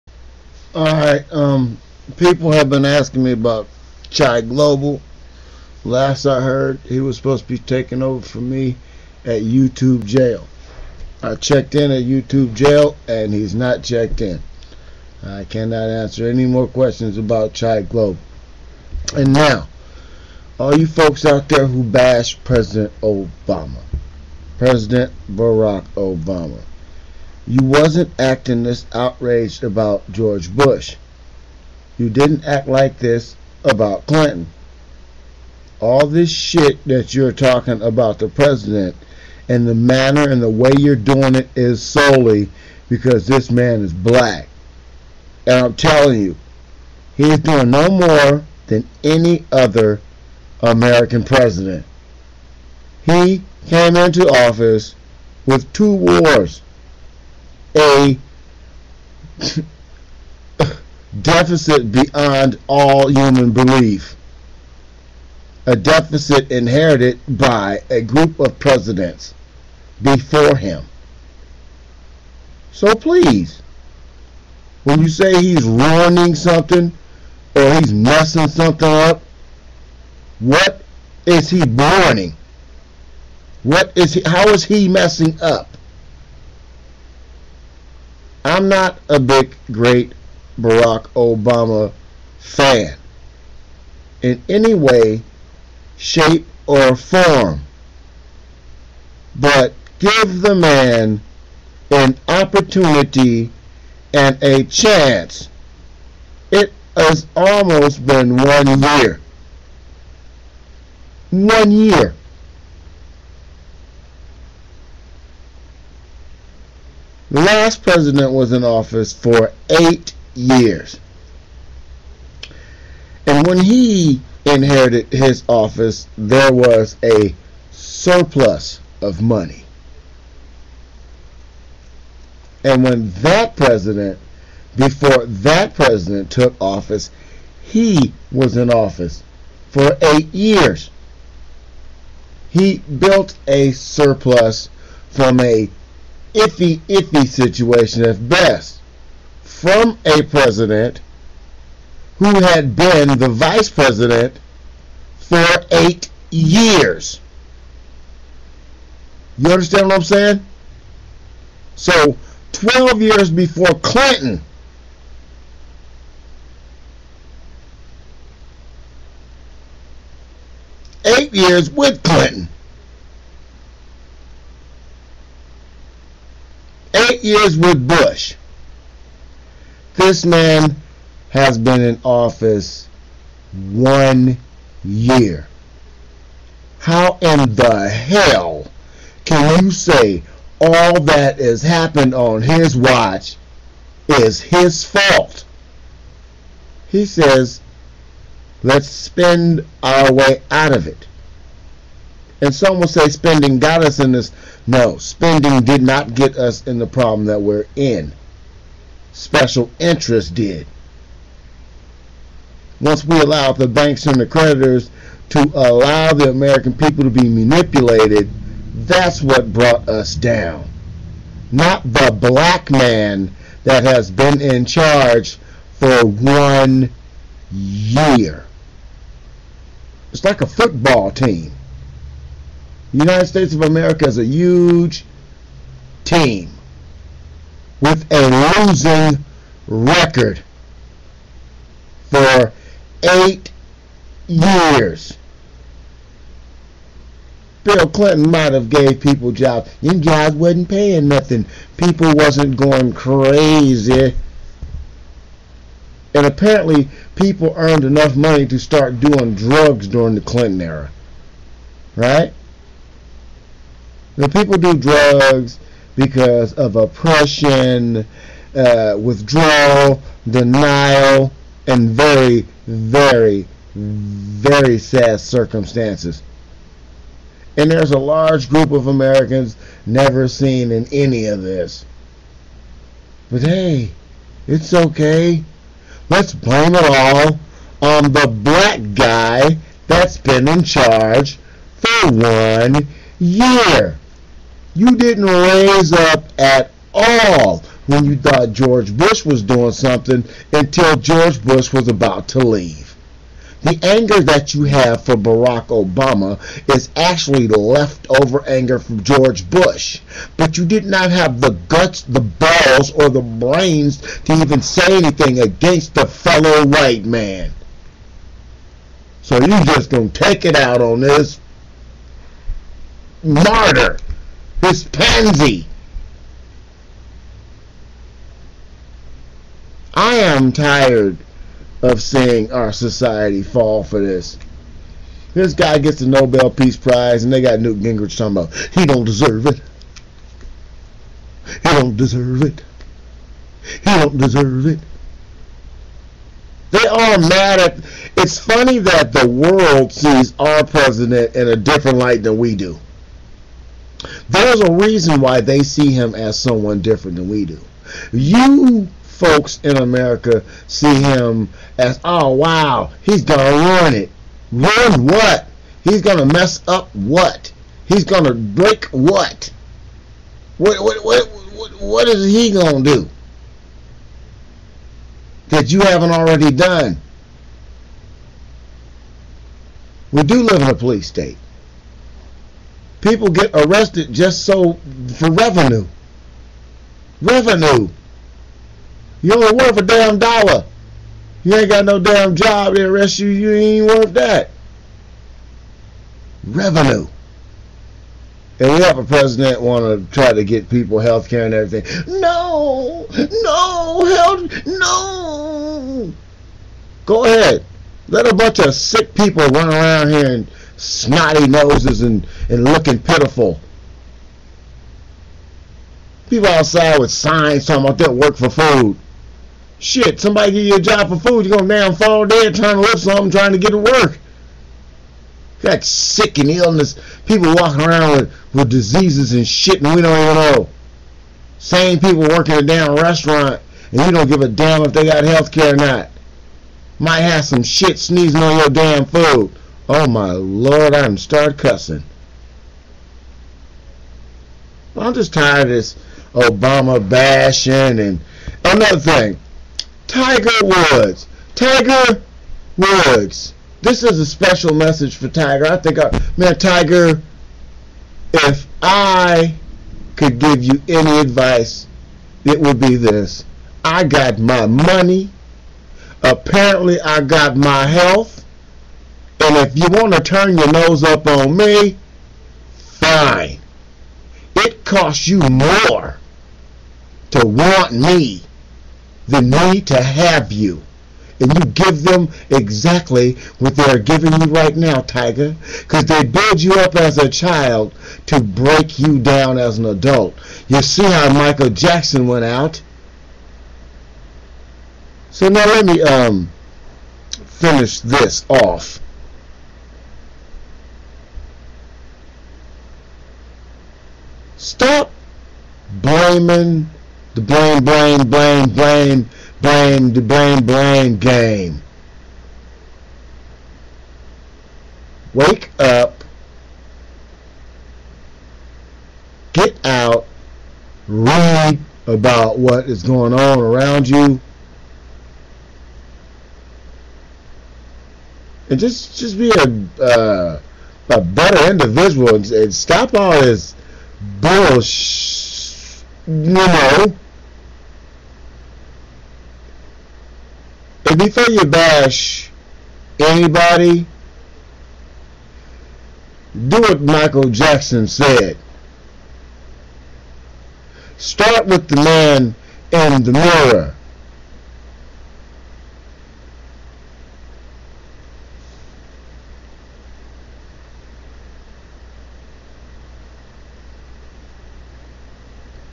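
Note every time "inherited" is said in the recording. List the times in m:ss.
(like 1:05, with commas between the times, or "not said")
1:06, 2:04.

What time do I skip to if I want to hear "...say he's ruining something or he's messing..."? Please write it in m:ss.
1:15.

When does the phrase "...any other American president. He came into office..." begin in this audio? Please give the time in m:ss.
0:49.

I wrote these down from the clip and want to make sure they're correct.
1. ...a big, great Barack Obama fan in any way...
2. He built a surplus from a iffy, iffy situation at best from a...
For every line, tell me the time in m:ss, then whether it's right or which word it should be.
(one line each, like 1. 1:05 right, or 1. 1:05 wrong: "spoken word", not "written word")
1. 1:29 right
2. 2:22 right.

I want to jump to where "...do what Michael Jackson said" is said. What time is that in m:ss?
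9:06.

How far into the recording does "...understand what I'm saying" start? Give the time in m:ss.
2:39.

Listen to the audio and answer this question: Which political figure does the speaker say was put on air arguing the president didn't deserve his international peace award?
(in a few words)
Newt Gingrich.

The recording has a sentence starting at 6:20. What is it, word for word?
We do live in a police state.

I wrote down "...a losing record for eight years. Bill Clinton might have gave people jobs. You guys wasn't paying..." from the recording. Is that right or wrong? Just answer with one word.
right.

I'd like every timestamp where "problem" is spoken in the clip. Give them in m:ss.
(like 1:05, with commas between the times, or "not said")
3:26.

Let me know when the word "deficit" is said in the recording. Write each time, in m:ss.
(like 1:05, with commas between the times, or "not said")
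1:01, 1:05.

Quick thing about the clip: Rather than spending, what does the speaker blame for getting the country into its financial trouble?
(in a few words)
Special interest.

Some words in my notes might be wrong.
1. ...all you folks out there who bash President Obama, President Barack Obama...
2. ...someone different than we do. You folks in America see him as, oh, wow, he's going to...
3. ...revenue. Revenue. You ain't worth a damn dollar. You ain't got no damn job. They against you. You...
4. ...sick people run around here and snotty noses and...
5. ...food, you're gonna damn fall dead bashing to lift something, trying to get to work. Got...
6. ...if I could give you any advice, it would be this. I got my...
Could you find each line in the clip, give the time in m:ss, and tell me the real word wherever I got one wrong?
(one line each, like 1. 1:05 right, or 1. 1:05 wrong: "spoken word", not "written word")
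1. 0:20 right
2. 5:56 right
3. 6:25 wrong: "arrest", not "against"
4. 6:48 right
5. 7:01 wrong: "trying", not "bashing"
6. 7:38 right.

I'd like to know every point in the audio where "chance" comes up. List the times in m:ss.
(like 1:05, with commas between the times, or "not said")
1:44.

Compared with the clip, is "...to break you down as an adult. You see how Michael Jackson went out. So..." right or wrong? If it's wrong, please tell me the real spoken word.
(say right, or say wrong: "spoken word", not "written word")
right.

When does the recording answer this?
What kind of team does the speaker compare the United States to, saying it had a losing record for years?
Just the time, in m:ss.
3:50.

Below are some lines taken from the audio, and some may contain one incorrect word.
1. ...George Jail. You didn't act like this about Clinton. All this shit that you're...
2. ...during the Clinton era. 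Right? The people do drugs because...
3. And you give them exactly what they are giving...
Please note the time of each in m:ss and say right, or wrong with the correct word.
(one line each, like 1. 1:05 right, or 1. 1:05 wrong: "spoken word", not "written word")
1. 0:30 wrong: "Bush", not "Jail"
2. 4:19 right
3. 8:01 right.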